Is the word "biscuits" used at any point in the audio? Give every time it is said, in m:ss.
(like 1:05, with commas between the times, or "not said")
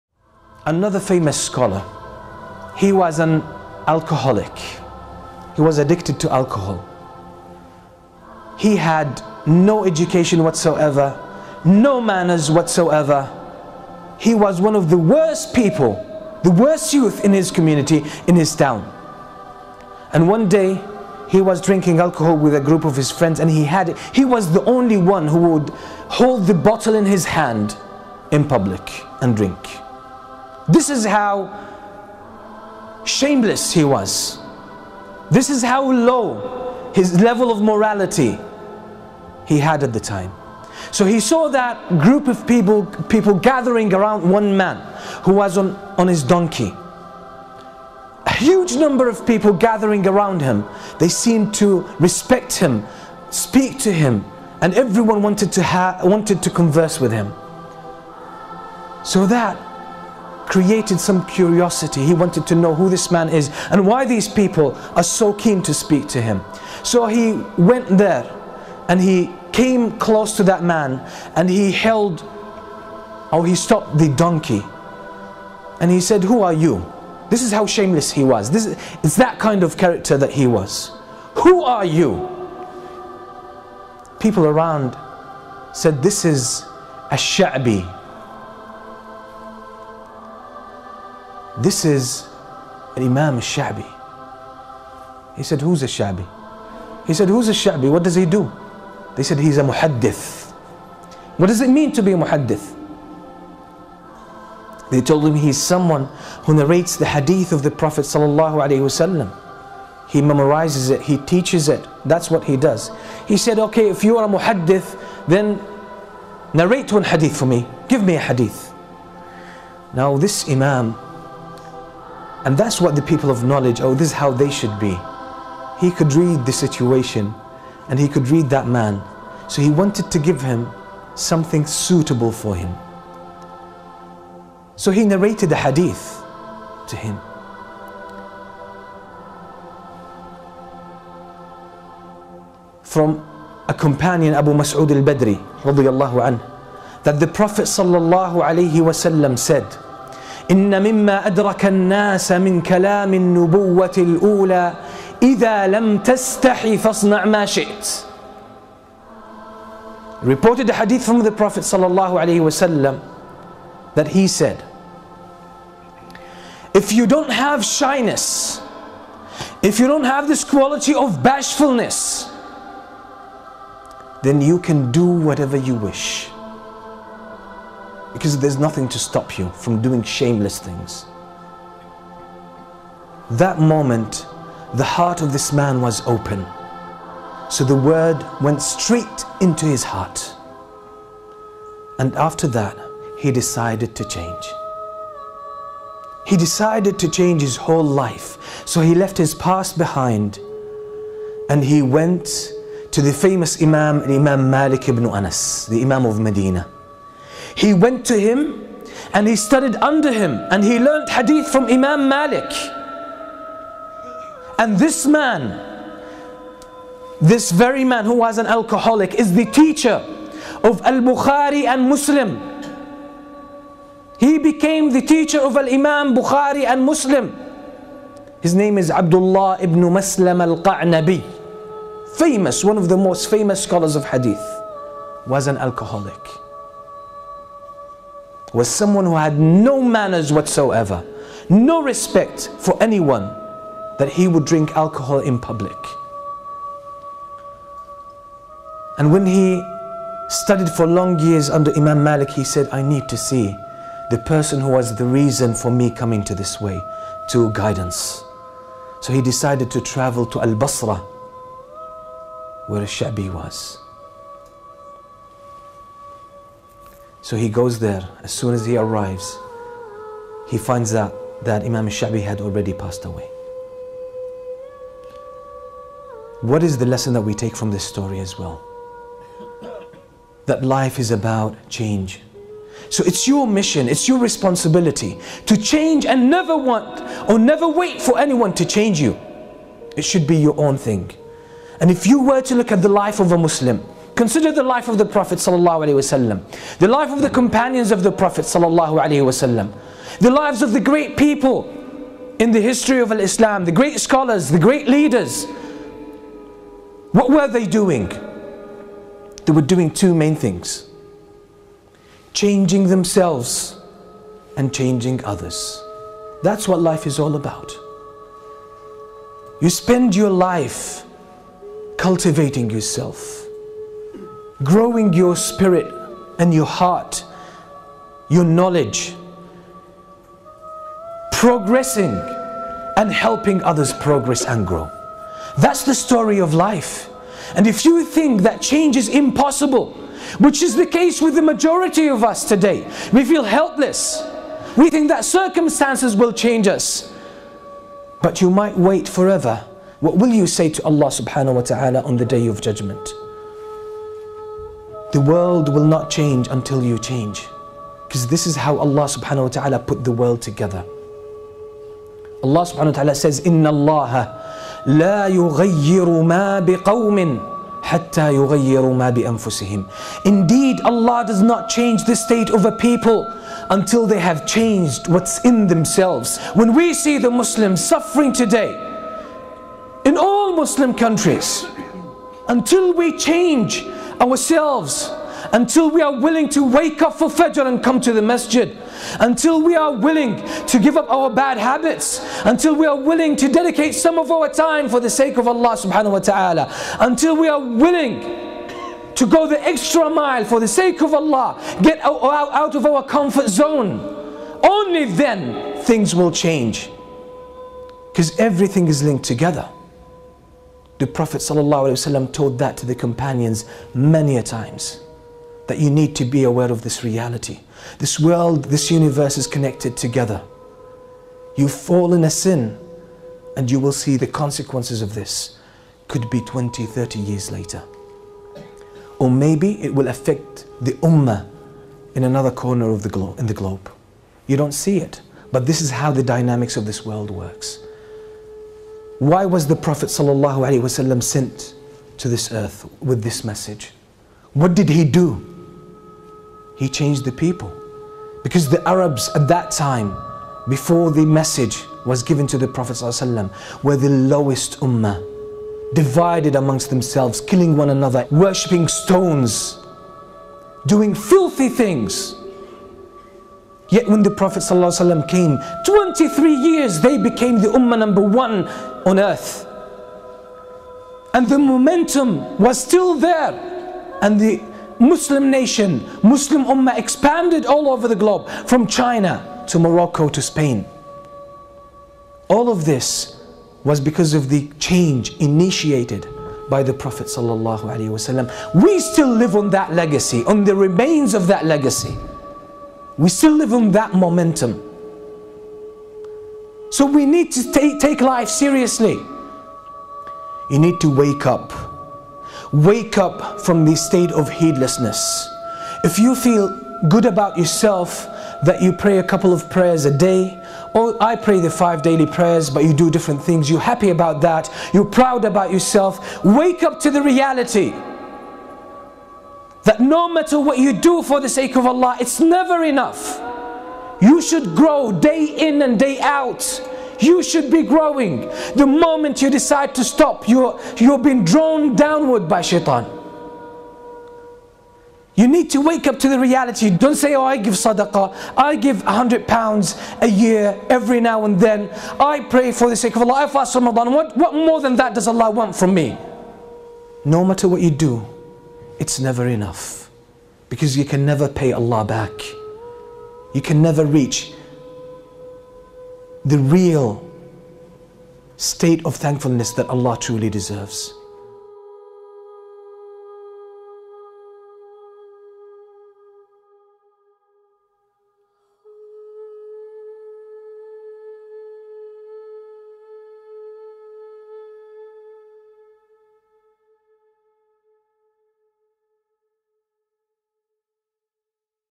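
not said.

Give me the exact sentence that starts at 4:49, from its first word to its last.
It should be your own thing.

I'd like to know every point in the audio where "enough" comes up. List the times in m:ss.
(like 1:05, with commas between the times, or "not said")
8:42, 9:09.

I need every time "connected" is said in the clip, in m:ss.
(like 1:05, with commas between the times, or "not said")
6:59.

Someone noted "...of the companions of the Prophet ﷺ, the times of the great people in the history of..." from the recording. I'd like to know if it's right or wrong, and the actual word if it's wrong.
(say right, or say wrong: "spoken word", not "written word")
wrong: "lives", not "times".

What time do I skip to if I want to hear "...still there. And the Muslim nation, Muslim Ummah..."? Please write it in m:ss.
7:52.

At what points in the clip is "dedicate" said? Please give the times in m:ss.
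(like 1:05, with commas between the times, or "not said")
6:33.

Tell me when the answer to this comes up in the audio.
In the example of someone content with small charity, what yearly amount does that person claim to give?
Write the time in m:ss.
8:59.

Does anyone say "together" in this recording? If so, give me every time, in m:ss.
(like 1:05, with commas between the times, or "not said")
6:00, 6:49, 6:59.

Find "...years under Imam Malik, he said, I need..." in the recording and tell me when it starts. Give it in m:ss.
4:11.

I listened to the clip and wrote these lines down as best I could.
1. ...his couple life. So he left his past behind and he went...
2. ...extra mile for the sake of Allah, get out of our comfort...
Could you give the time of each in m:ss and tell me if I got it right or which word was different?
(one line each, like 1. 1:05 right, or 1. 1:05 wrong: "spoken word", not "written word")
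1. 3:17 wrong: "whole", not "couple"
2. 6:39 right.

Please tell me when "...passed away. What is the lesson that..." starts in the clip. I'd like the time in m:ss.
4:32.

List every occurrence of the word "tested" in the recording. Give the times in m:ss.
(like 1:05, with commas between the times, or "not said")
not said.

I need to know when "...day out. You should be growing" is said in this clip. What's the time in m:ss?
8:45.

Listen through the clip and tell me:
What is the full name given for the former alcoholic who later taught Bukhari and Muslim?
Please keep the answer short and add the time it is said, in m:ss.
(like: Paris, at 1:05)
Abdullah ibn Maslam al Qa'nabi, at 3:48.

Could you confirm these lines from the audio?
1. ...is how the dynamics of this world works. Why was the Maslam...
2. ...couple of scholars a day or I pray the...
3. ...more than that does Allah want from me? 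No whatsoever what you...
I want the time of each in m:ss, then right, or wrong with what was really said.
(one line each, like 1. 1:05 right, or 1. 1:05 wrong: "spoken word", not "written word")
1. 7:15 wrong: "Prophet", not "Maslam"
2. 8:29 wrong: "prayers", not "scholars"
3. 9:04 wrong: "matter", not "whatsoever".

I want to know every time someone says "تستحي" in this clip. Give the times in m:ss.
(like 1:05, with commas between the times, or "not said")
2:35.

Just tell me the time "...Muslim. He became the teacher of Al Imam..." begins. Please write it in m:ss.
3:41.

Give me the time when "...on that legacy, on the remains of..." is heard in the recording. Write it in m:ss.
8:09.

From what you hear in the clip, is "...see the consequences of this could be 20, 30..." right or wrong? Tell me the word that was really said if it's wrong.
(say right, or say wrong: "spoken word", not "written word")
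right.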